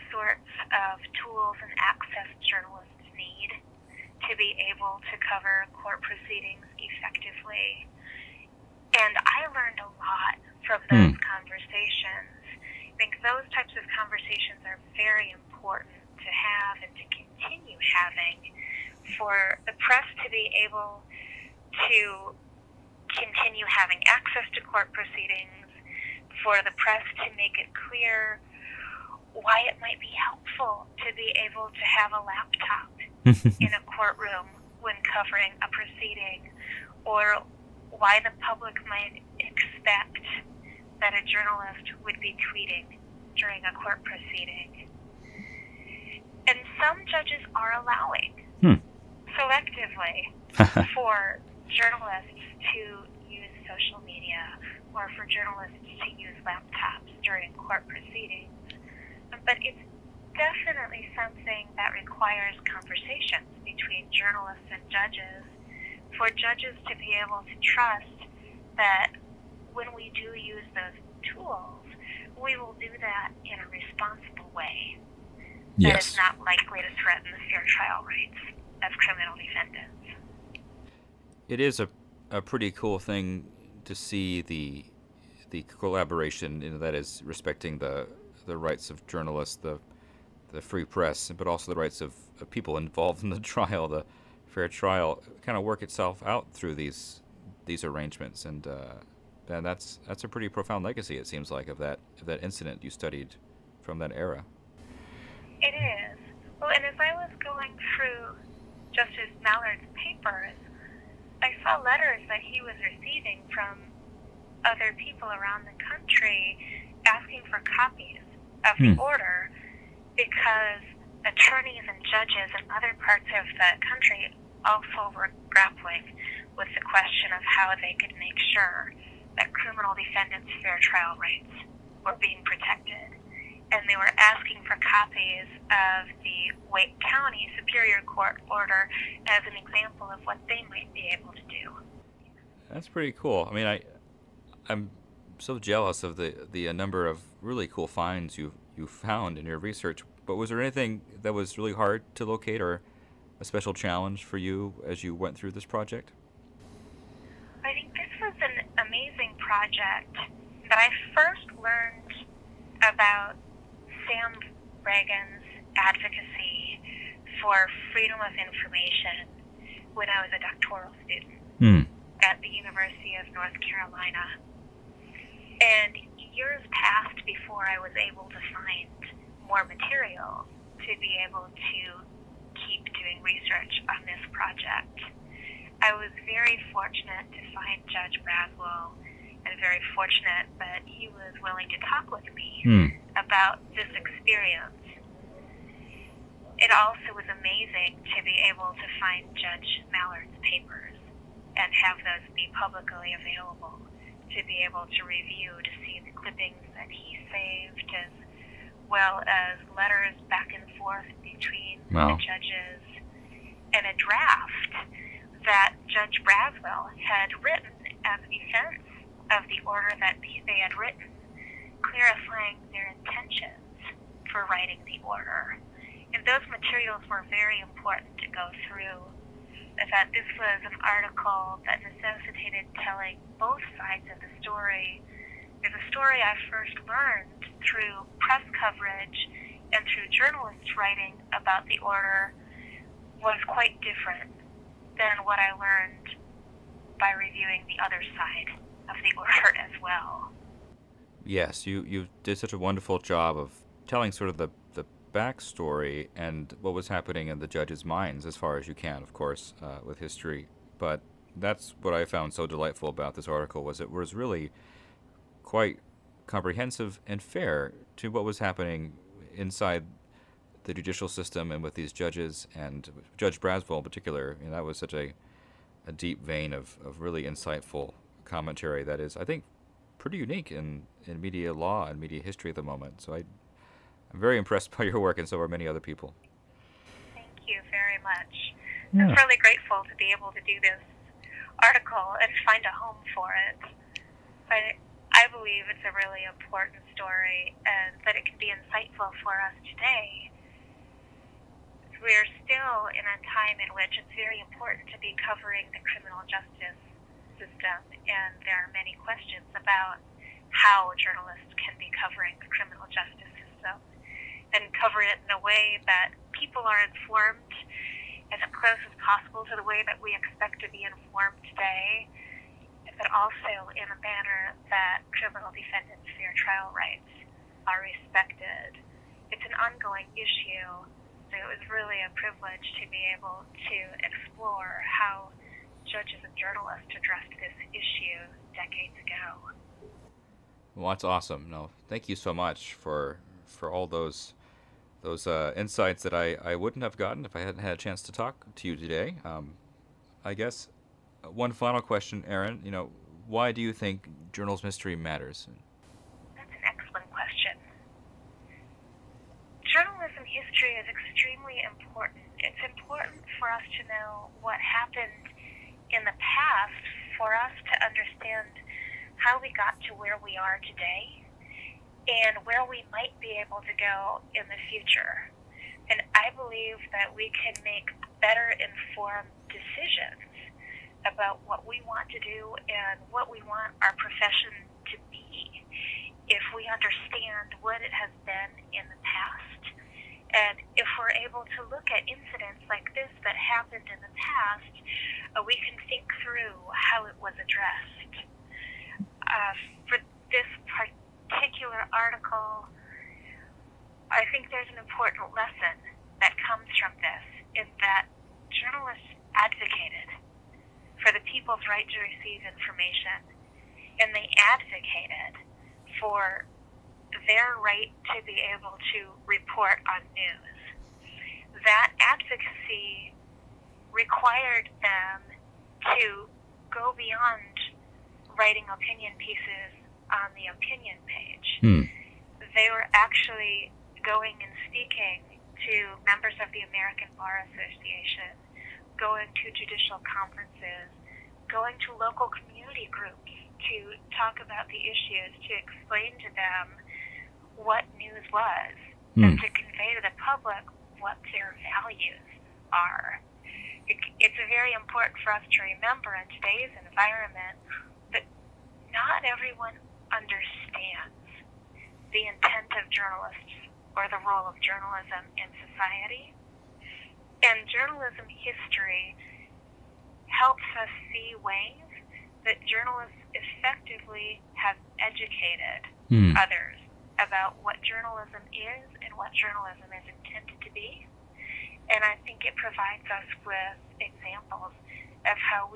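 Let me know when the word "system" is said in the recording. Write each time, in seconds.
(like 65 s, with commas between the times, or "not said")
271 s, 307 s, 313 s.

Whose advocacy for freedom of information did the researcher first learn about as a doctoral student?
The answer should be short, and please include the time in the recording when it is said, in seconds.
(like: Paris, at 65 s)
Sam Ragan, at 164 s.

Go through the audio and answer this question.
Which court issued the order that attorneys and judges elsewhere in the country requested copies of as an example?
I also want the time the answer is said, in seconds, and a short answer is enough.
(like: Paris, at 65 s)
Wake County Superior Court, at 136 s.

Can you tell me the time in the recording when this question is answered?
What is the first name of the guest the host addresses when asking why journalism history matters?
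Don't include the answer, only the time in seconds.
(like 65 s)
352 s.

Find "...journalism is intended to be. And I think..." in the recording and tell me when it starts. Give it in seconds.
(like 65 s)
479 s.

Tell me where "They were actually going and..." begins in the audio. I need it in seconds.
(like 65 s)
432 s.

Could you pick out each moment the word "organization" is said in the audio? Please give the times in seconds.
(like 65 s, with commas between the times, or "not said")
not said.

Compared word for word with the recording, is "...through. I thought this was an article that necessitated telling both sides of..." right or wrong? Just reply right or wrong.
right.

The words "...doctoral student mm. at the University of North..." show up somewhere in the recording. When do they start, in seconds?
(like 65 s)
170 s.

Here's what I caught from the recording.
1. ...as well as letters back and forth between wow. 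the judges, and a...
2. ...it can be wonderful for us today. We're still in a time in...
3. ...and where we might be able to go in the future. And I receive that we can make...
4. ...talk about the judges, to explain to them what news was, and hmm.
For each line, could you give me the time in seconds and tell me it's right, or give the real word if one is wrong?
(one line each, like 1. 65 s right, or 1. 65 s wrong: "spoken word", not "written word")
1. 207 s right
2. 298 s wrong: "insightful", not "wonderful"
3. 372 s wrong: "believe", not "receive"
4. 444 s wrong: "issues", not "judges".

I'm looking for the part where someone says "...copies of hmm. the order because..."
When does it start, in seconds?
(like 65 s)
117 s.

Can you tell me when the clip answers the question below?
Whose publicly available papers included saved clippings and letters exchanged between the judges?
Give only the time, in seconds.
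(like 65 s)
199 s.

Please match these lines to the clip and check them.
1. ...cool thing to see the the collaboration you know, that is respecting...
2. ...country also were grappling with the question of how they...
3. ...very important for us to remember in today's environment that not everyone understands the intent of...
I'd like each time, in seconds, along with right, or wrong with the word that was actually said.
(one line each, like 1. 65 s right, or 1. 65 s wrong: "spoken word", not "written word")
1. 82 s right
2. 123 s right
3. 454 s right.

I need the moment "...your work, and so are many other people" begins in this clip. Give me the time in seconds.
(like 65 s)
284 s.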